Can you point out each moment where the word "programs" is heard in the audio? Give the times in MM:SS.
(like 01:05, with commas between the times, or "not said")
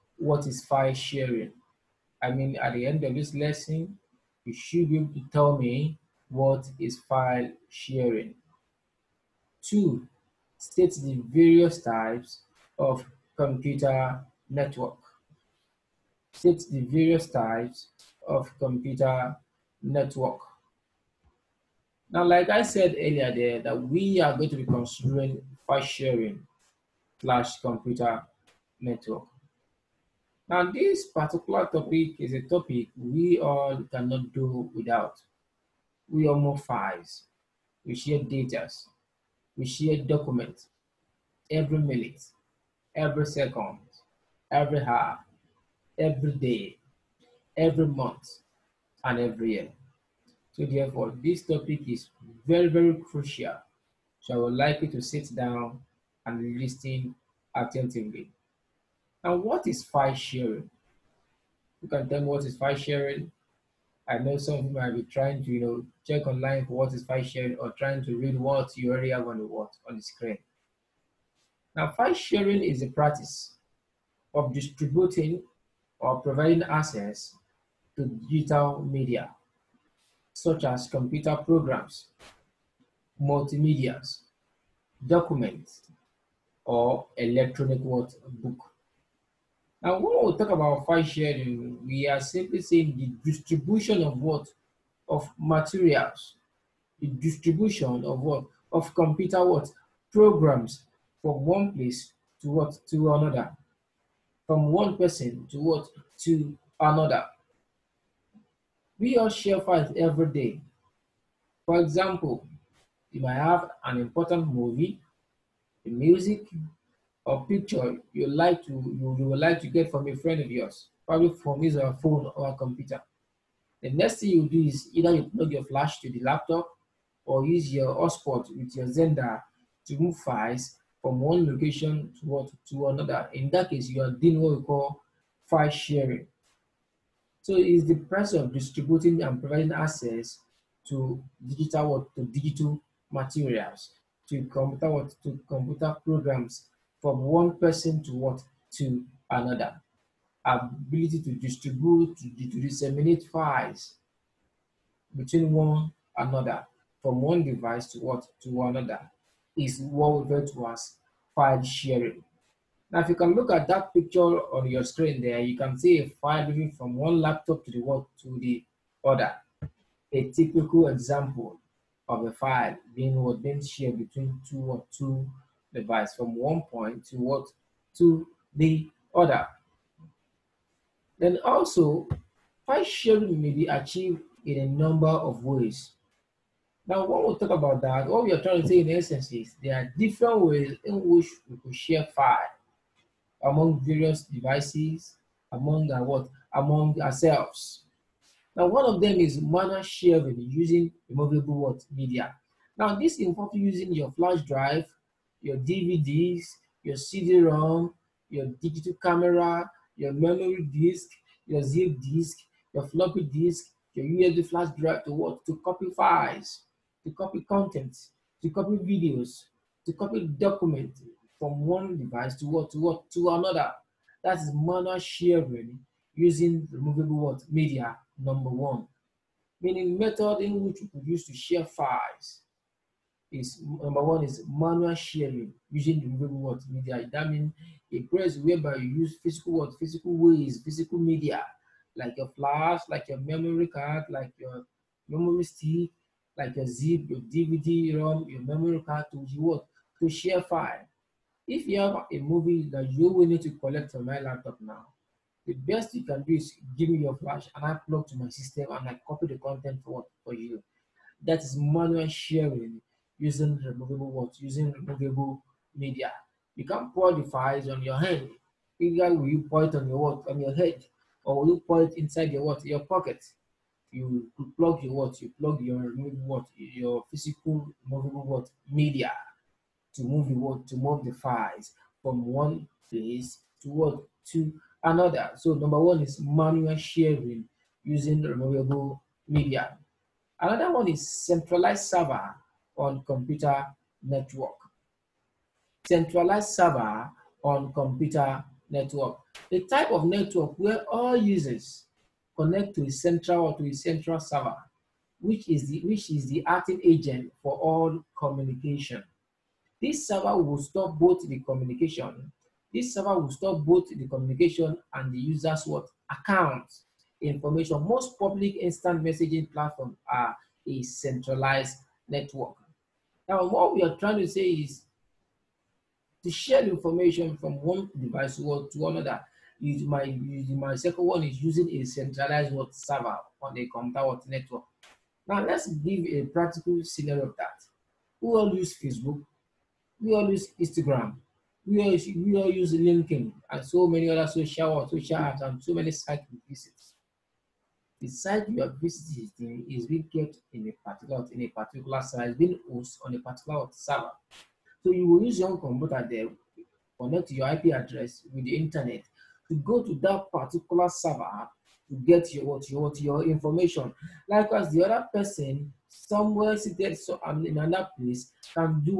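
01:21, 01:40, 02:26.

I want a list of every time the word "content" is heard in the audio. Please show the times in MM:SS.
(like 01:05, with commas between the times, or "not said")
03:37, 04:19.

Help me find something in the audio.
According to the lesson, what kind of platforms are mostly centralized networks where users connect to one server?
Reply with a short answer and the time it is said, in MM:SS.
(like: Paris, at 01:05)
public instant messaging platforms, at 05:18.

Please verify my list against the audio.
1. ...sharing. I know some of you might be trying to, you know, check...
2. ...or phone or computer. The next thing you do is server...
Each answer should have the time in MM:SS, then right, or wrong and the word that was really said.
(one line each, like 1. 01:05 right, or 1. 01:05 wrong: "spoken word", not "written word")
1. 01:02 right
2. 02:01 wrong: "either", not "server".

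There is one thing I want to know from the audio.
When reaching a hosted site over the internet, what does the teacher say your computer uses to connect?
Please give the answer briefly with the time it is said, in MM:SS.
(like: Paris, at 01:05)
your IP address, at 05:57.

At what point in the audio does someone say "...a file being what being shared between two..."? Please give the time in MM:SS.
02:52.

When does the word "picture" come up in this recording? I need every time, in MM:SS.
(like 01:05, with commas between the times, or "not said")
01:57, 02:43.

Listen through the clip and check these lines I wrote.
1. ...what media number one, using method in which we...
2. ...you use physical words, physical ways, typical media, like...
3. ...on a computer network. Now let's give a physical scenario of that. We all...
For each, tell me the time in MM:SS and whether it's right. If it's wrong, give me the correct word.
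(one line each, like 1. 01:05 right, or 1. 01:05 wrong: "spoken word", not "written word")
1. 03:47 wrong: "meaning", not "using"
2. 03:58 wrong: "physical", not "typical"
3. 05:33 wrong: "practical", not "physical".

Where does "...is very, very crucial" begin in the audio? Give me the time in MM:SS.
00:51.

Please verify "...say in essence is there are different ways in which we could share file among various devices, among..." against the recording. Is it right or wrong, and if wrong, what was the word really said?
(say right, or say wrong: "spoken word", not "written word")
right.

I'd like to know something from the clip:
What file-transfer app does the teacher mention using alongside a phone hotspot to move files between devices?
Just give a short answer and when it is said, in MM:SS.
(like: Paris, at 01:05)
Xender, at 02:08.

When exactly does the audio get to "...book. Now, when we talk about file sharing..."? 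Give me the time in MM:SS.
01:28.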